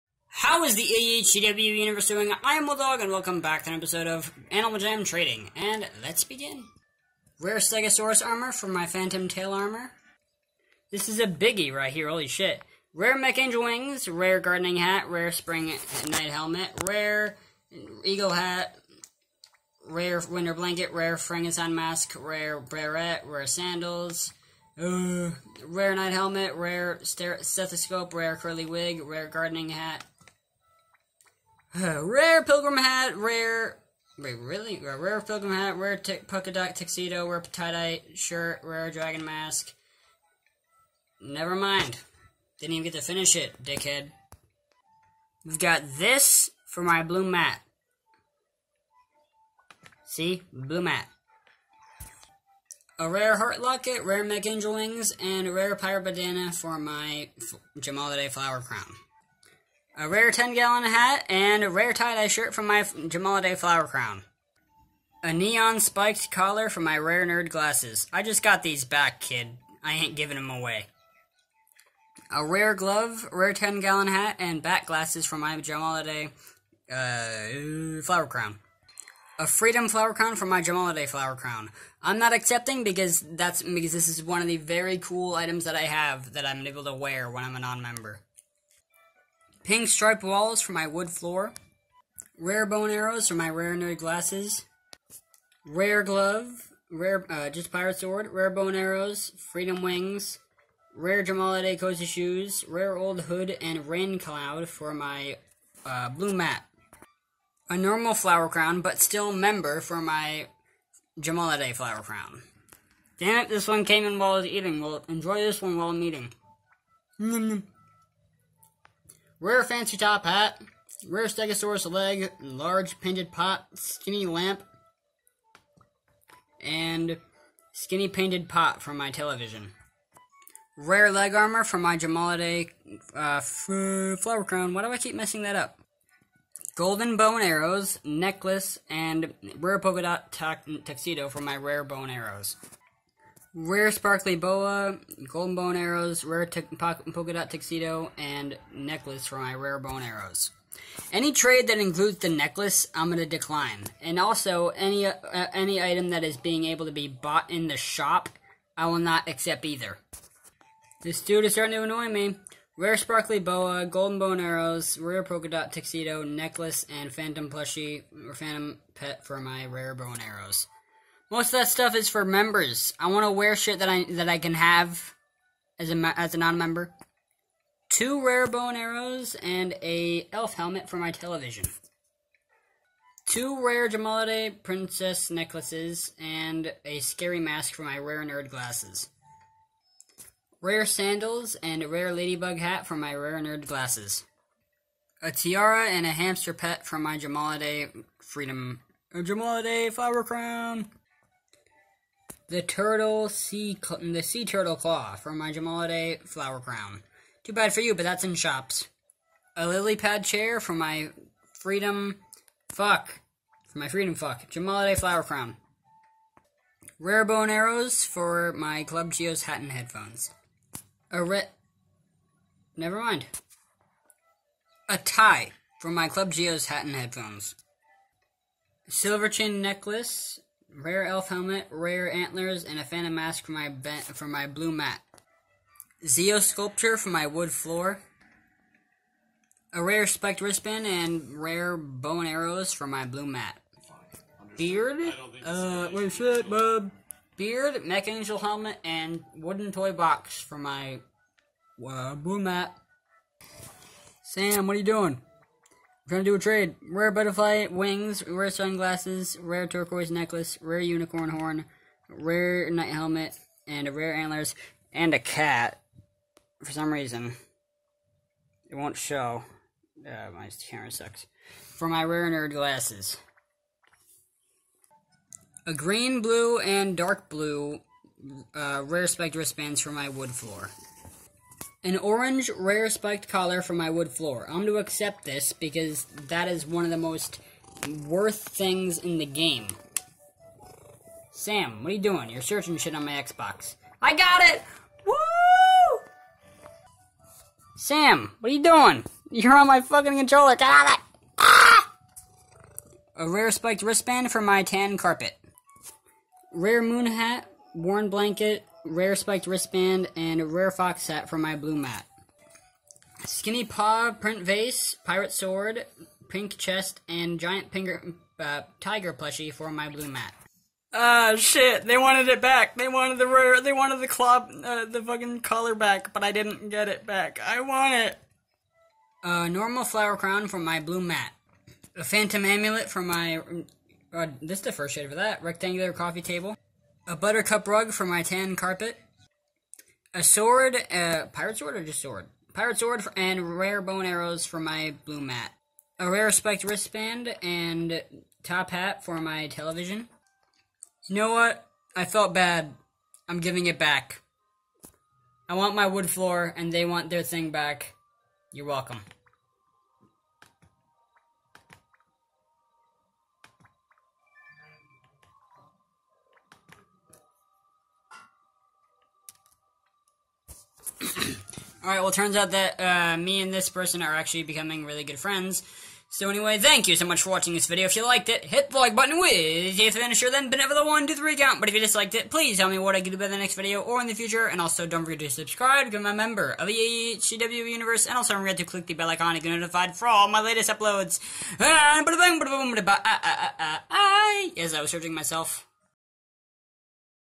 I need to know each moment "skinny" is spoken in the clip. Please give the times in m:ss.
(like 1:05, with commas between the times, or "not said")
2:03, 2:07, 5:13.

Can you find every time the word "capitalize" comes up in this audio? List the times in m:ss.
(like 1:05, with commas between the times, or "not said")
not said.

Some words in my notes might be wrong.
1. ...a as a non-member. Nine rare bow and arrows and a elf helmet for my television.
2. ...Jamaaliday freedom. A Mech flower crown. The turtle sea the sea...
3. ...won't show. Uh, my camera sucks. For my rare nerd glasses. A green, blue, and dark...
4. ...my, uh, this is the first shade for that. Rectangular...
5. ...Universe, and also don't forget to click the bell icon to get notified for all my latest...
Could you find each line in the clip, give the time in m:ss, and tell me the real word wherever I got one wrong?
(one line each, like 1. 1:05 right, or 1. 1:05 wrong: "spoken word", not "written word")
1. 2:55 wrong: "Two", not "Nine"
2. 3:17 wrong: "Jamaaliday", not "Mech"
3. 4:28 right
4. 5:33 right
5. 6:27 right.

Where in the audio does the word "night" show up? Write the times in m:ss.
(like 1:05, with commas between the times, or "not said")
0:15, 0:25, 4:22.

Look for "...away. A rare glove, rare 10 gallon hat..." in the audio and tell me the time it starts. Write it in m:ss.
1:10.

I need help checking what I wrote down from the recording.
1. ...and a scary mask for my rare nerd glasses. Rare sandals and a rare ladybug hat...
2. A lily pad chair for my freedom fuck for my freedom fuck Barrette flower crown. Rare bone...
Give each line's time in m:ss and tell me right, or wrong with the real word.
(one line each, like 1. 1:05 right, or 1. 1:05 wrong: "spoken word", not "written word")
1. 3:06 right
2. 3:29 wrong: "Jamaaliday", not "Barrette".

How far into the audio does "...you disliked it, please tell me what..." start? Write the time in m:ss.
6:21.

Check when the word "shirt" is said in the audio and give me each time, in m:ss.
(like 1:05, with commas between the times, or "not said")
0:38, 1:02.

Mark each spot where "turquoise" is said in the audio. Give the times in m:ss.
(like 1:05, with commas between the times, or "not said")
4:19.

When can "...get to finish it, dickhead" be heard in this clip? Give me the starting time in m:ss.
0:42.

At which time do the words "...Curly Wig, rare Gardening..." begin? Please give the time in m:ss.
0:28.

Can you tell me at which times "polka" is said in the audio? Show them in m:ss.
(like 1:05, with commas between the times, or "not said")
0:36, 2:19, 2:26, 2:45.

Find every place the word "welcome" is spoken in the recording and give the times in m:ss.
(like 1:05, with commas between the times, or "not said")
0:03, 5:58.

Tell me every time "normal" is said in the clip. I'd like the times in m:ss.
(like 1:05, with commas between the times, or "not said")
1:47, 5:29.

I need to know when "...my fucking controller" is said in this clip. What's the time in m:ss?
4:59.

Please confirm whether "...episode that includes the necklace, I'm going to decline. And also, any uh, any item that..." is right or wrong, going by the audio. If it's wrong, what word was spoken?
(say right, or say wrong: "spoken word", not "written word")
wrong: "trade", not "episode".